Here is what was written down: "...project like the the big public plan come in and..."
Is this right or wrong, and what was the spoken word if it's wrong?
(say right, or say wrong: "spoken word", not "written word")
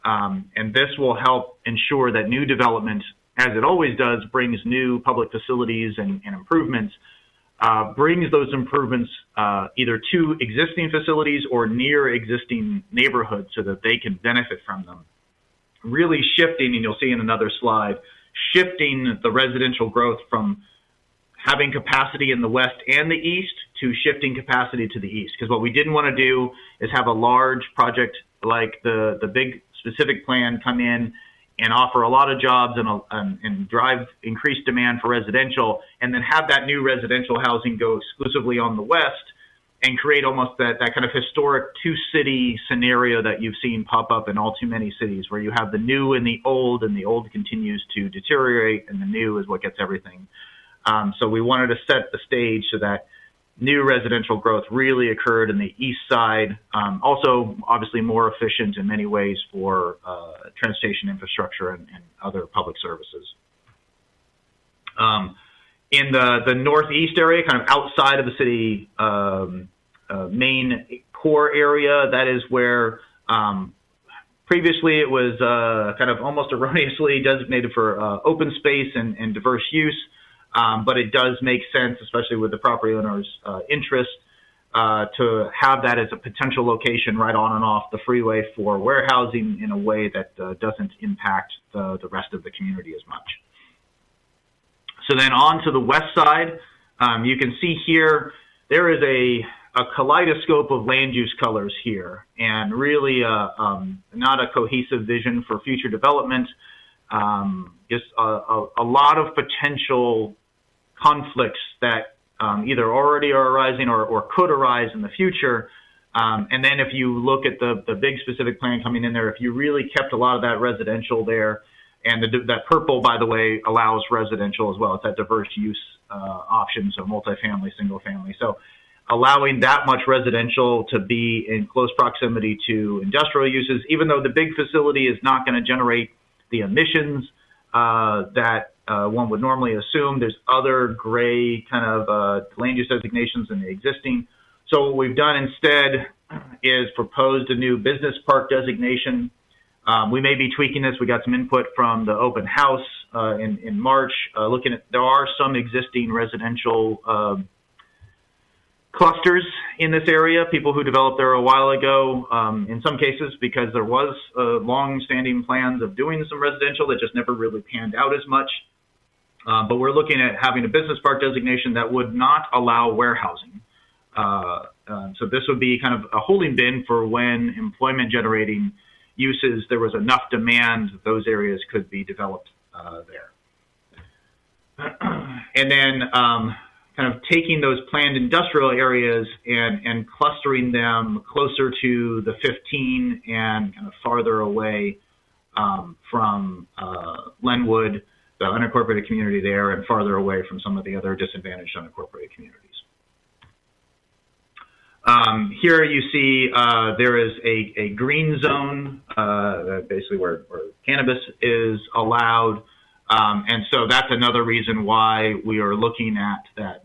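wrong: "specific", not "public".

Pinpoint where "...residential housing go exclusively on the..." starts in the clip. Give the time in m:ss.
0:36.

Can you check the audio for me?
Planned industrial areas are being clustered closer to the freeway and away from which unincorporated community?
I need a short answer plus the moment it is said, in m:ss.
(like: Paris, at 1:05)
Lenwood, at 3:17.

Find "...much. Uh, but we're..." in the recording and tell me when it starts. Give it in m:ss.
2:48.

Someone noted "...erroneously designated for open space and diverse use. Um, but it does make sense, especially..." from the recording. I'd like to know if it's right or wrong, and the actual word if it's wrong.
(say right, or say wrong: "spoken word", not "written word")
right.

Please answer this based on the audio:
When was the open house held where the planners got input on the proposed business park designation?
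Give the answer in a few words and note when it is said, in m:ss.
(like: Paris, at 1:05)
March, at 2:33.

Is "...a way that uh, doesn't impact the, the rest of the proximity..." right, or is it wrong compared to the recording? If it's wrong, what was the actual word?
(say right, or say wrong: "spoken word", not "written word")
wrong: "community", not "proximity".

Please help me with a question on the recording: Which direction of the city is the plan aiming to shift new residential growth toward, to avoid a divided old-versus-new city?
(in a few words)
East side.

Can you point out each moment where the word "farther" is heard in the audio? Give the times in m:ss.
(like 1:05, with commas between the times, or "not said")
3:14, 3:19.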